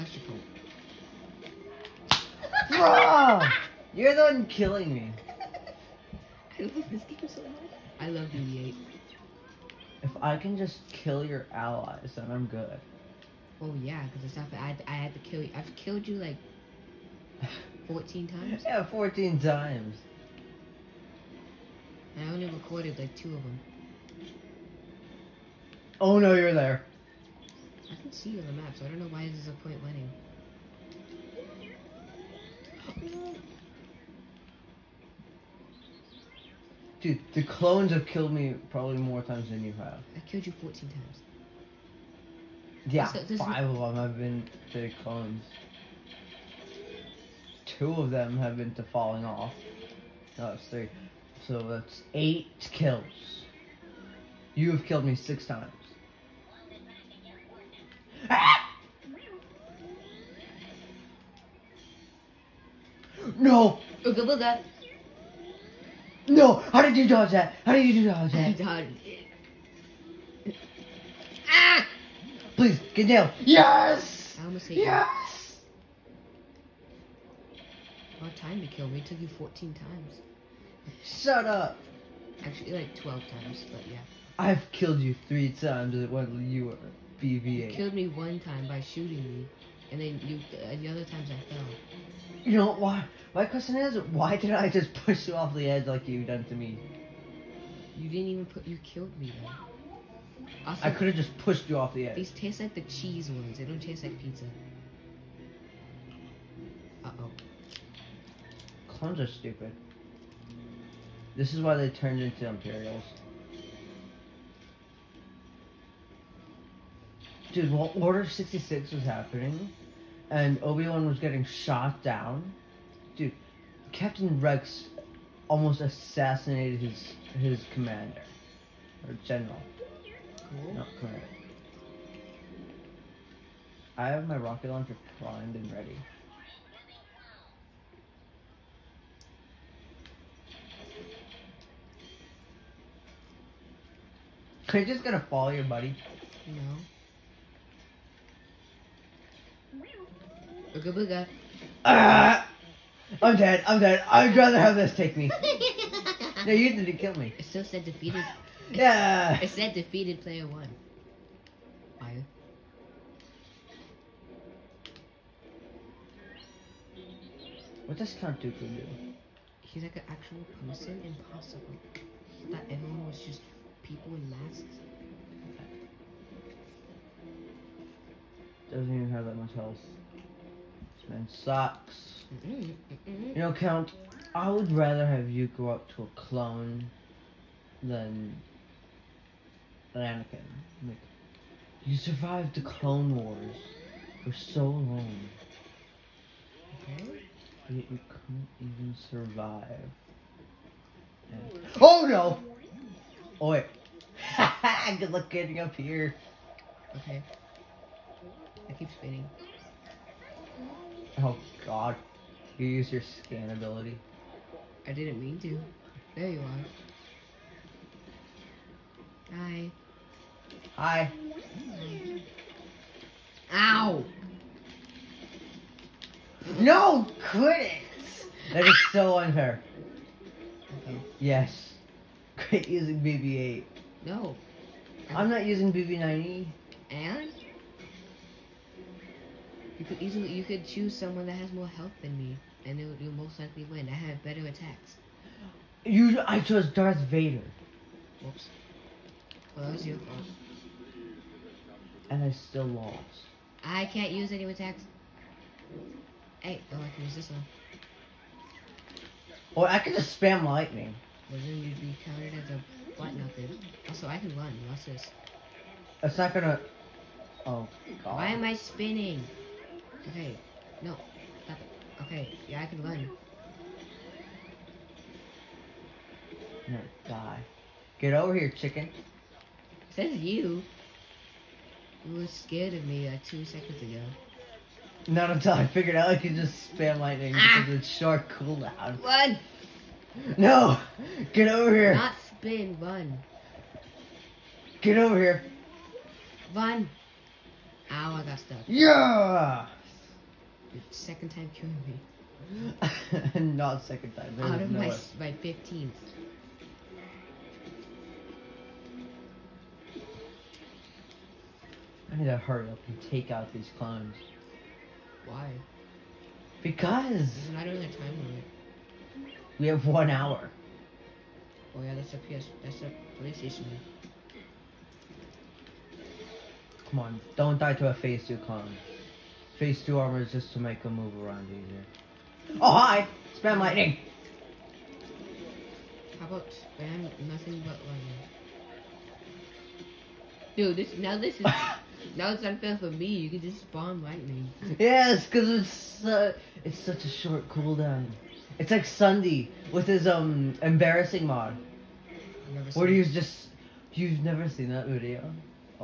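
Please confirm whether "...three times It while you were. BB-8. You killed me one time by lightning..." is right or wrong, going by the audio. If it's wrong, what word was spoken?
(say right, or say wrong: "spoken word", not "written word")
wrong: "shooting", not "lightning".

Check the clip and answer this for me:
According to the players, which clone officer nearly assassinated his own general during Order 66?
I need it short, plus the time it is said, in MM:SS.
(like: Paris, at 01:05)
Captain Rex, at 02:03.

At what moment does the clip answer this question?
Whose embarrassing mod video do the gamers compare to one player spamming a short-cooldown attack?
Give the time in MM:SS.
05:48.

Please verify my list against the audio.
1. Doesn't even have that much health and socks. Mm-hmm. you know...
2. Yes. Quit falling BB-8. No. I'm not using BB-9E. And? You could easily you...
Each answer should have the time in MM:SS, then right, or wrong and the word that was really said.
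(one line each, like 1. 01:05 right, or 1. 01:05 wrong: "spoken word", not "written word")
1. 02:58 right
2. 03:51 wrong: "using", not "falling".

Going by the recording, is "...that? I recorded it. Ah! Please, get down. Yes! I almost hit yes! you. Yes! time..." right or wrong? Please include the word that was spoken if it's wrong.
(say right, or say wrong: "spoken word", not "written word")
wrong: "dodged", not "recorded".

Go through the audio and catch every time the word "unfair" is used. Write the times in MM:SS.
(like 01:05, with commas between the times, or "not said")
03:49, 05:42.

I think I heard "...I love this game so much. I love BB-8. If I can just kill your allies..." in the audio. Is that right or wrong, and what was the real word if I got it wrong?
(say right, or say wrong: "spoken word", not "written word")
right.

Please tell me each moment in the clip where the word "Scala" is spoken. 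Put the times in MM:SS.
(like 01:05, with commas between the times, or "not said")
not said.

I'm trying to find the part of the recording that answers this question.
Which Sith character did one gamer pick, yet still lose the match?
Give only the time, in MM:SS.
04:06.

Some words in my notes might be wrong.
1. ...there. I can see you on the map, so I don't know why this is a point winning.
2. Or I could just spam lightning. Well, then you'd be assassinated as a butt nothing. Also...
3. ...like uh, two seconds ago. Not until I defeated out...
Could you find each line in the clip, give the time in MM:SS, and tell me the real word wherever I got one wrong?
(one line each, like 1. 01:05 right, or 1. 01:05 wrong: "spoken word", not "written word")
1. 00:26 right
2. 04:19 wrong: "counted", not "assassinated"
3. 04:43 wrong: "figured", not "defeated".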